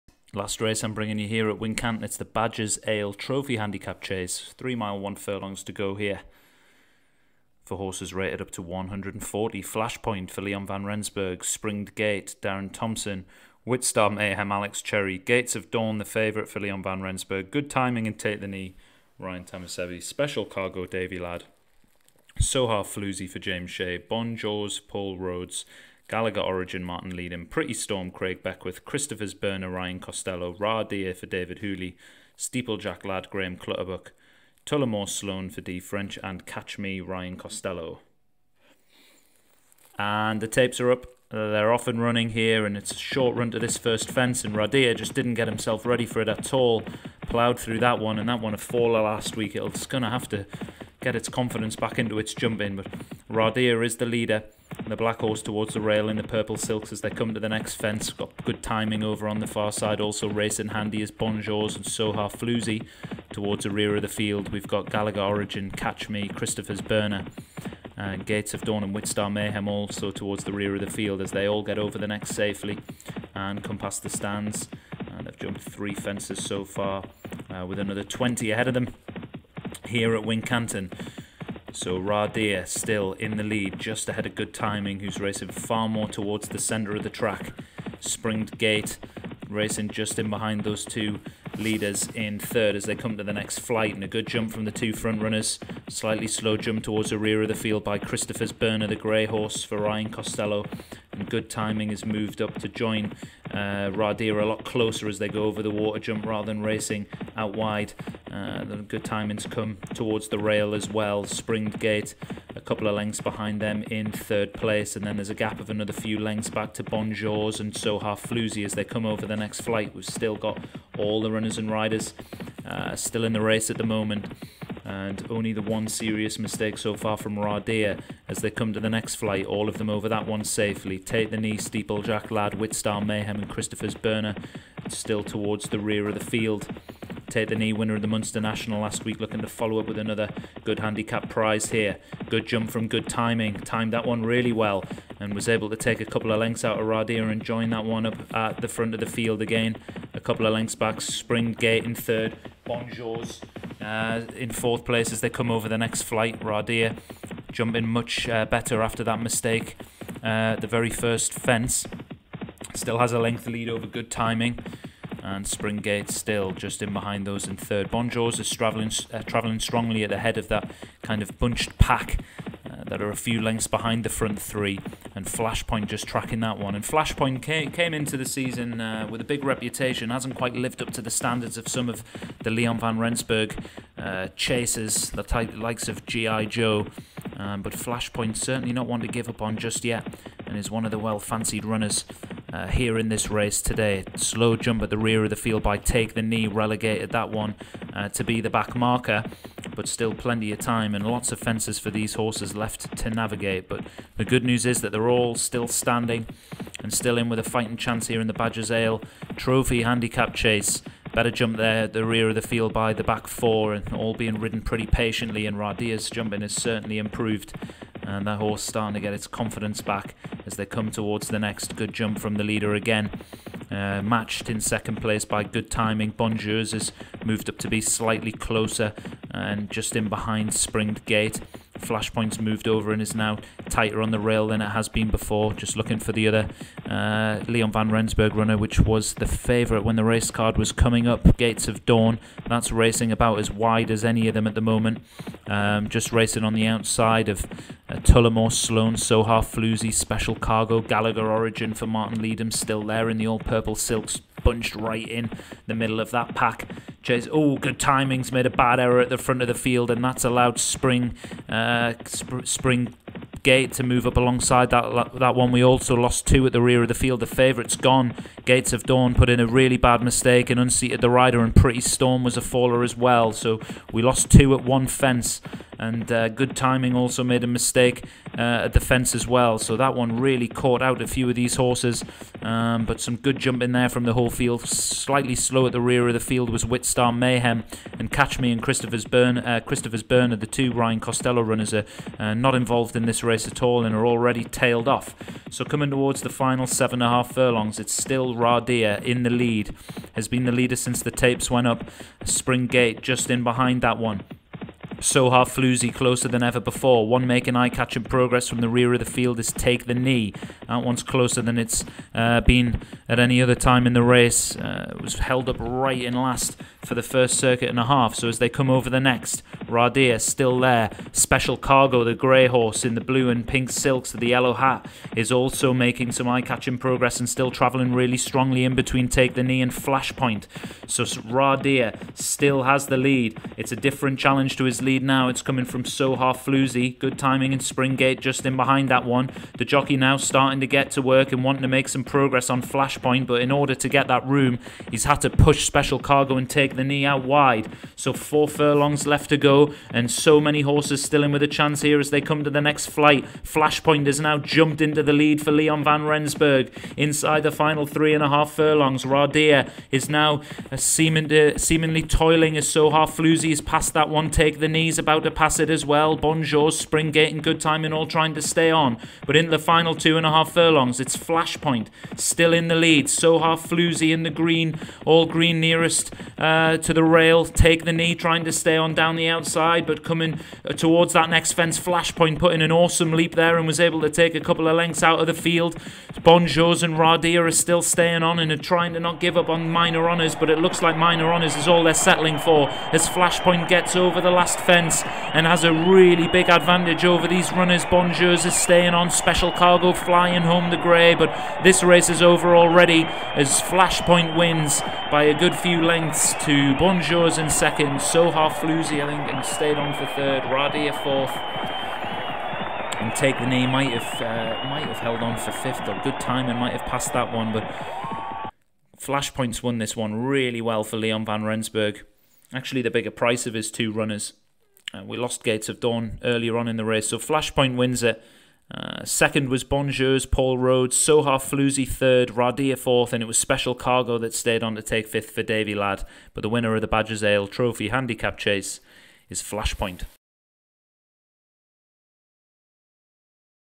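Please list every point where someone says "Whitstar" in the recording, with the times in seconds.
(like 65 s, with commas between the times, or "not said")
13 s, 68 s, 132 s, 286 s.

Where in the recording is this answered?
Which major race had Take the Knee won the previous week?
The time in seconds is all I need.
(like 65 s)
138 s.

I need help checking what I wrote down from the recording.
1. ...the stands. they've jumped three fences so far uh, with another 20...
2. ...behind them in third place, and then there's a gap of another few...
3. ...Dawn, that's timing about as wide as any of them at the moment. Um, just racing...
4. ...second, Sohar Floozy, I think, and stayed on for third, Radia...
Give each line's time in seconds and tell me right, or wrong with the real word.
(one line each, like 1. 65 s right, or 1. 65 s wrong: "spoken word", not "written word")
1. 74 s right
2. 113 s right
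3. 241 s wrong: "racing", not "timing"
4. 407 s right.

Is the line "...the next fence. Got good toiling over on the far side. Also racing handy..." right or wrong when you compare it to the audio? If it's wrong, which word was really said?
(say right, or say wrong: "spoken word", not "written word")
wrong: "timing", not "toiling".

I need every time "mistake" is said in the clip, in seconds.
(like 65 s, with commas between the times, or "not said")
126 s, 159 s, 270 s, 277 s.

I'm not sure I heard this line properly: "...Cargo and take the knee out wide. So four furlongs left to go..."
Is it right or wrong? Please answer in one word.
right.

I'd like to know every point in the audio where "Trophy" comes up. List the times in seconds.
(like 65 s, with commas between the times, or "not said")
3 s, 209 s, 437 s.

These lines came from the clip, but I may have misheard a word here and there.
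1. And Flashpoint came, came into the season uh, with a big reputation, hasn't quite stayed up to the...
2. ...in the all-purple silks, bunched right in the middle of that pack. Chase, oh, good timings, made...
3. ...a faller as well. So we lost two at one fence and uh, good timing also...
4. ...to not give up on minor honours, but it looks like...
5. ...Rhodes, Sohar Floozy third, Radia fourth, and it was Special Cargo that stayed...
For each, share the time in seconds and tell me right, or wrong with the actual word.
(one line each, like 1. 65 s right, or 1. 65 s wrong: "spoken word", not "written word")
1. 176 s wrong: "lived", not "stayed"
2. 253 s right
3. 272 s right
4. 388 s right
5. 430 s right.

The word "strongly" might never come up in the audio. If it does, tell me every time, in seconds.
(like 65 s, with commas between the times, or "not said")
169 s, 328 s.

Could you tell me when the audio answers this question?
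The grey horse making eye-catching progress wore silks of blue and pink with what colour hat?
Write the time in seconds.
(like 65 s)
324 s.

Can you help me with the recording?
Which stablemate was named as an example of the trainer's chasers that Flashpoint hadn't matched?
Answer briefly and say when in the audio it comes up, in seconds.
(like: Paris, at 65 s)
G.I. Joe, at 186 s.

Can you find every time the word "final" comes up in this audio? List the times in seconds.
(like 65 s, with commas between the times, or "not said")
296 s, 357 s, 369 s.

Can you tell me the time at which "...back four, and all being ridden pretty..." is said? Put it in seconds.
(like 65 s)
213 s.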